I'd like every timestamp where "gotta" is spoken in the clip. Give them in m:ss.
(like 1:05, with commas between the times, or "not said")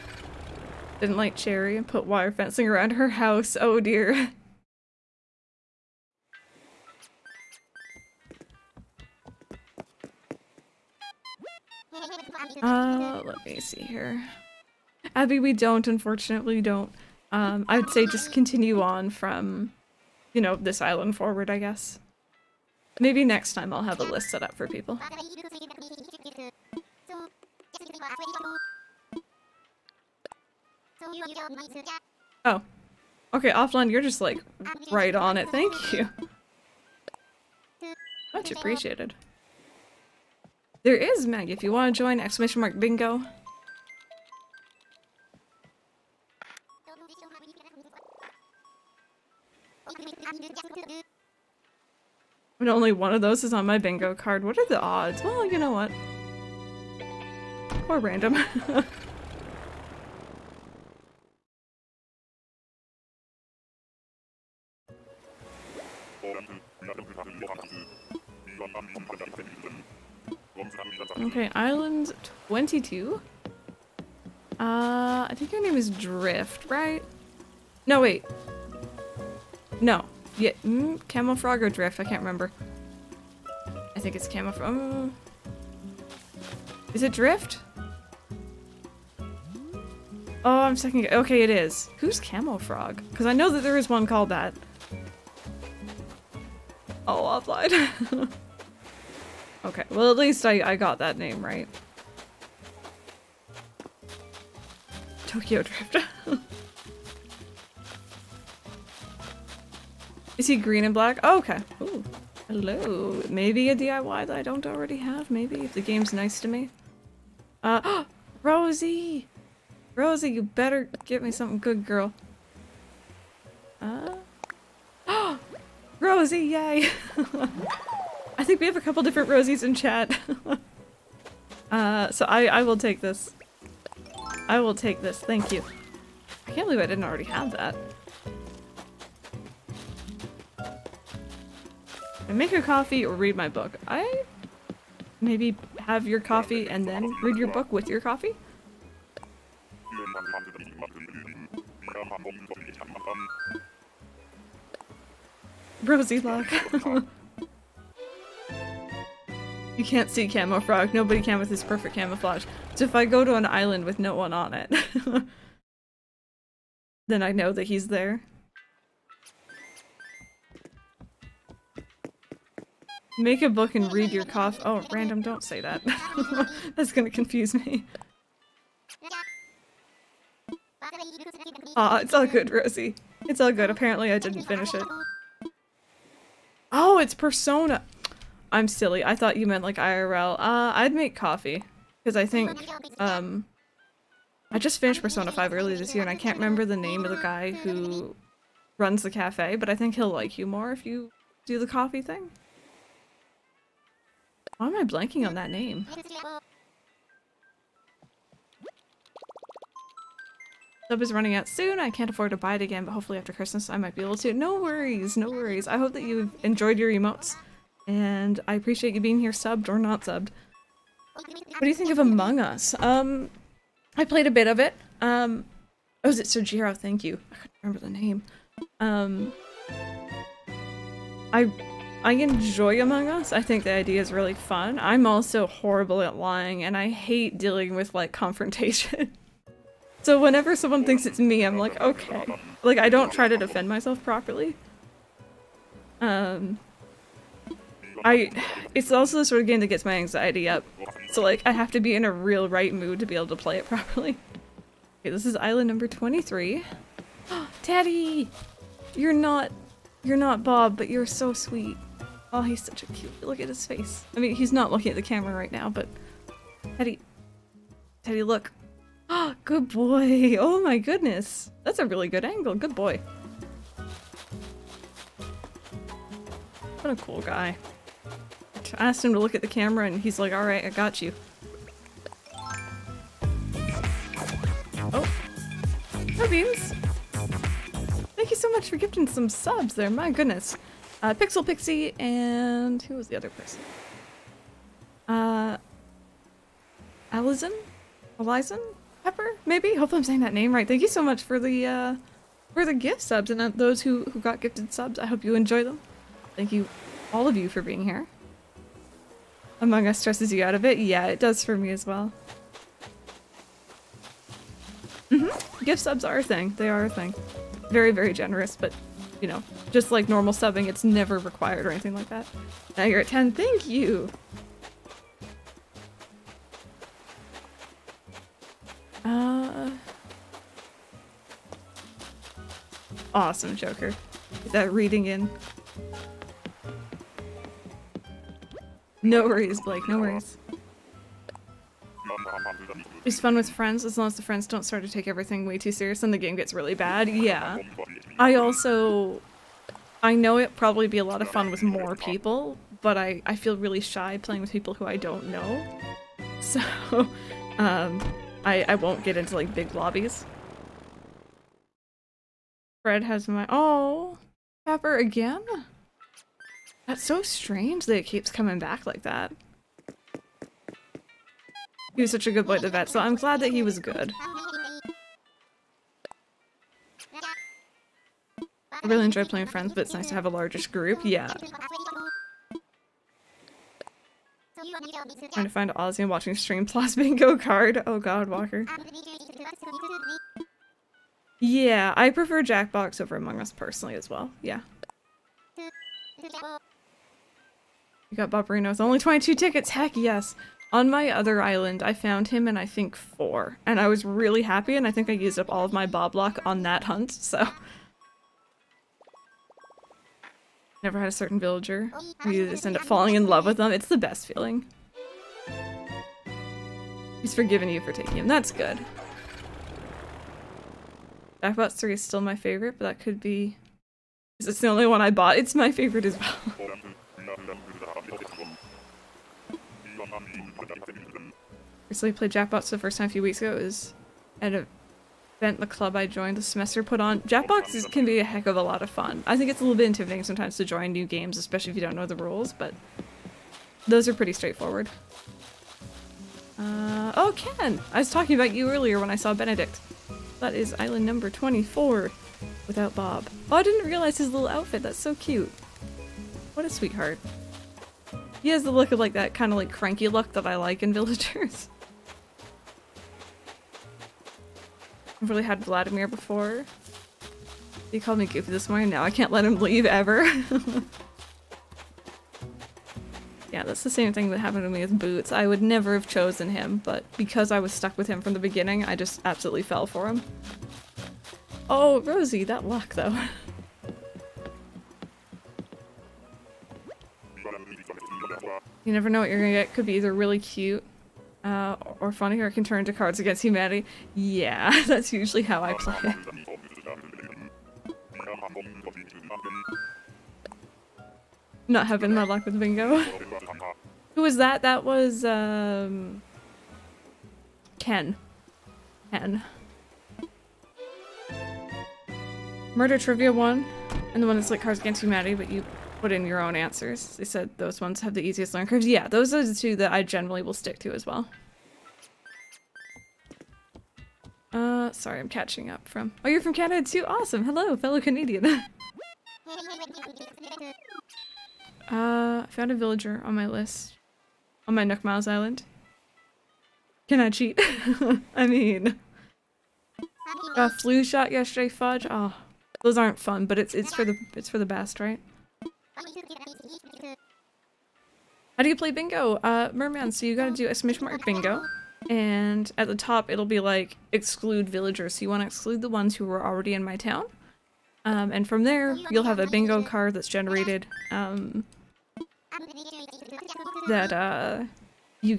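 9:10.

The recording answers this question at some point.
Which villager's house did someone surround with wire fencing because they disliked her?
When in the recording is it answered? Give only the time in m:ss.
0:01.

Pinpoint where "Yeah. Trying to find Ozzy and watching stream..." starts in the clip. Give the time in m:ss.
6:21.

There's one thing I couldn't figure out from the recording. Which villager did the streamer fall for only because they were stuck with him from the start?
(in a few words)
Boots.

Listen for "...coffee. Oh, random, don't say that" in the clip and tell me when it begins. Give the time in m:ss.
2:54.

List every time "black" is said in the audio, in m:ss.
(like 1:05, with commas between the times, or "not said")
1:50.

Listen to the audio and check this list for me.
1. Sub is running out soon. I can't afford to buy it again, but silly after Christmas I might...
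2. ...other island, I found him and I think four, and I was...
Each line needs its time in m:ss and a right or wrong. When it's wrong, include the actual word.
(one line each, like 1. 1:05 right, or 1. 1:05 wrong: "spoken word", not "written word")
1. 3:30 wrong: "hopefully", not "silly"
2. 6:41 right.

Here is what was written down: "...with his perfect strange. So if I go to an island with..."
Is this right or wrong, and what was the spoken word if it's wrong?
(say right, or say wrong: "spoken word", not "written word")
wrong: "camouflage", not "strange".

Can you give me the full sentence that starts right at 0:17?
Um, I'd say just continue on from you know, this island forward, I guess.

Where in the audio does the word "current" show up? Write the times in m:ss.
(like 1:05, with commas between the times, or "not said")
not said.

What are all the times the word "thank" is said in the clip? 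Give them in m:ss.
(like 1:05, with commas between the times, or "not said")
0:35, 2:15, 3:46, 4:48, 5:00, 5:06, 5:23.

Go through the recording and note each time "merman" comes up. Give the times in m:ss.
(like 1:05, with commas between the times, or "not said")
9:09.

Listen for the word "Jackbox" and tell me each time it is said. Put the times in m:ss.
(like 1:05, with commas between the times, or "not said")
6:32, 7:01, 7:12.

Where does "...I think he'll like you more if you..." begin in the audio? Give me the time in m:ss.
3:19.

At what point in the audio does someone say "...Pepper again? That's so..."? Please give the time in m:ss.
6:04.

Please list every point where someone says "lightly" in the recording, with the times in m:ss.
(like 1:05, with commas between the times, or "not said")
not said.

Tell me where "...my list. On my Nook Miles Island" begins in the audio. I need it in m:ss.
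8:53.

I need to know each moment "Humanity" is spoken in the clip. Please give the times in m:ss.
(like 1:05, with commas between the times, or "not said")
8:13, 8:35.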